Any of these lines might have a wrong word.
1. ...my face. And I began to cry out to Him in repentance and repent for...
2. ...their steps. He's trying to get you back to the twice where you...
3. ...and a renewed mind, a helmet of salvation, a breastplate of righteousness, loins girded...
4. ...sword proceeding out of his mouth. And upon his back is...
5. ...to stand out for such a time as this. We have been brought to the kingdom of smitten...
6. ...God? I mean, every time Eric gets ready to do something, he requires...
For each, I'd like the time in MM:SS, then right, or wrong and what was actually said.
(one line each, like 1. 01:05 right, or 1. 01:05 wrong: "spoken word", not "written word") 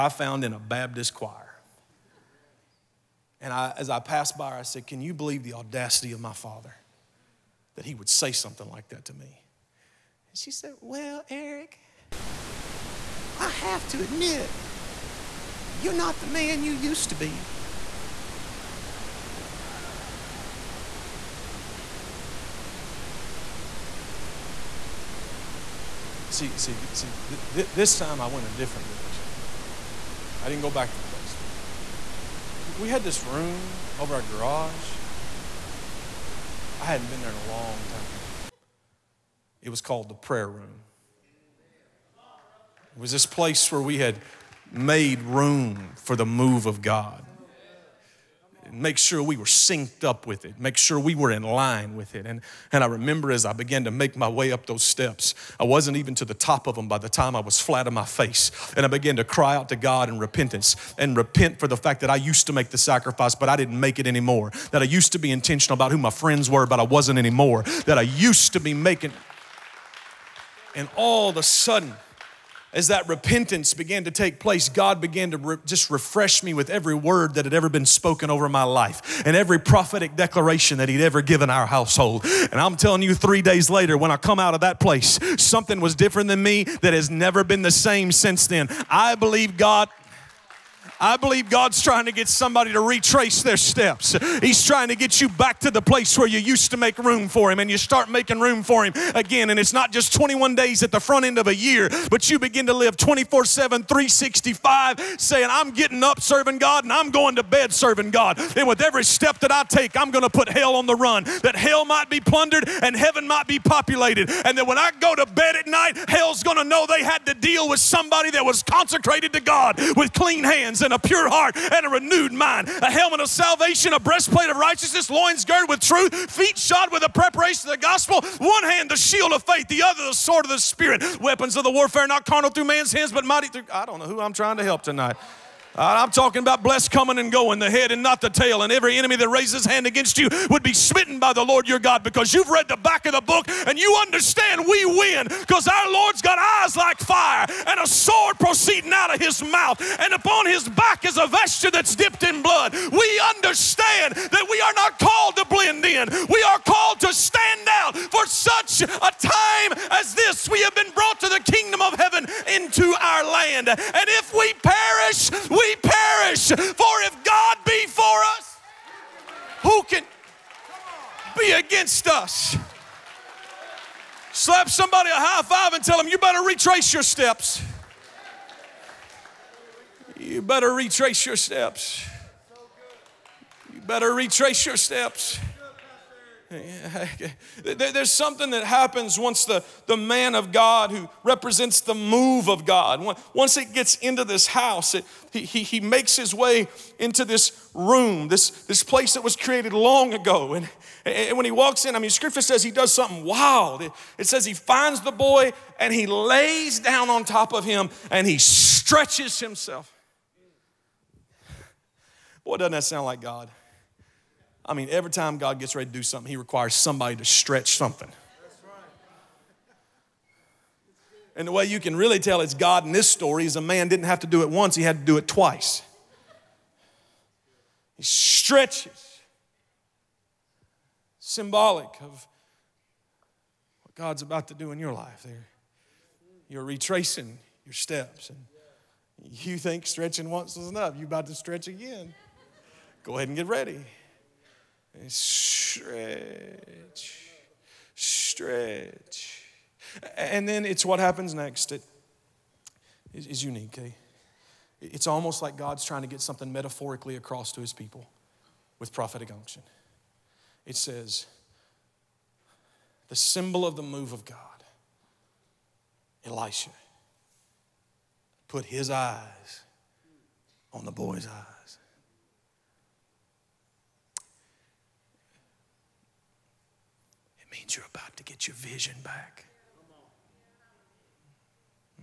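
1. 00:57 wrong: "God", not "Him"
2. 01:33 wrong: "place", not "twice"
3. 02:01 right
4. 02:27 right
5. 02:37 wrong: "heaven", not "smitten"
6. 03:33 wrong: "God", not "Eric".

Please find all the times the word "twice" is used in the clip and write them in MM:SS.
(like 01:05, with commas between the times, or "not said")
03:45.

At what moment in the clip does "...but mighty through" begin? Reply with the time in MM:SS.
02:13.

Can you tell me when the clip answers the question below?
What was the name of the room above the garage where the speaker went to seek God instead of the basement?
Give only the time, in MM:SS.
00:40.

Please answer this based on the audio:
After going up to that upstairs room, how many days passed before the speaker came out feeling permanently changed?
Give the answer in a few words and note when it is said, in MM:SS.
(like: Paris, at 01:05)
3 days, at 01:23.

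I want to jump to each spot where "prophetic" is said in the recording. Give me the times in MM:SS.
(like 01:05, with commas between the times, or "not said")
01:19, 04:18.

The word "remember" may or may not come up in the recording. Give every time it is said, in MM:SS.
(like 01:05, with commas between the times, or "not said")
00:52.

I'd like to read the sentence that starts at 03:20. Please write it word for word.
And, and when he walks in, I mean, scripture says he does something wild.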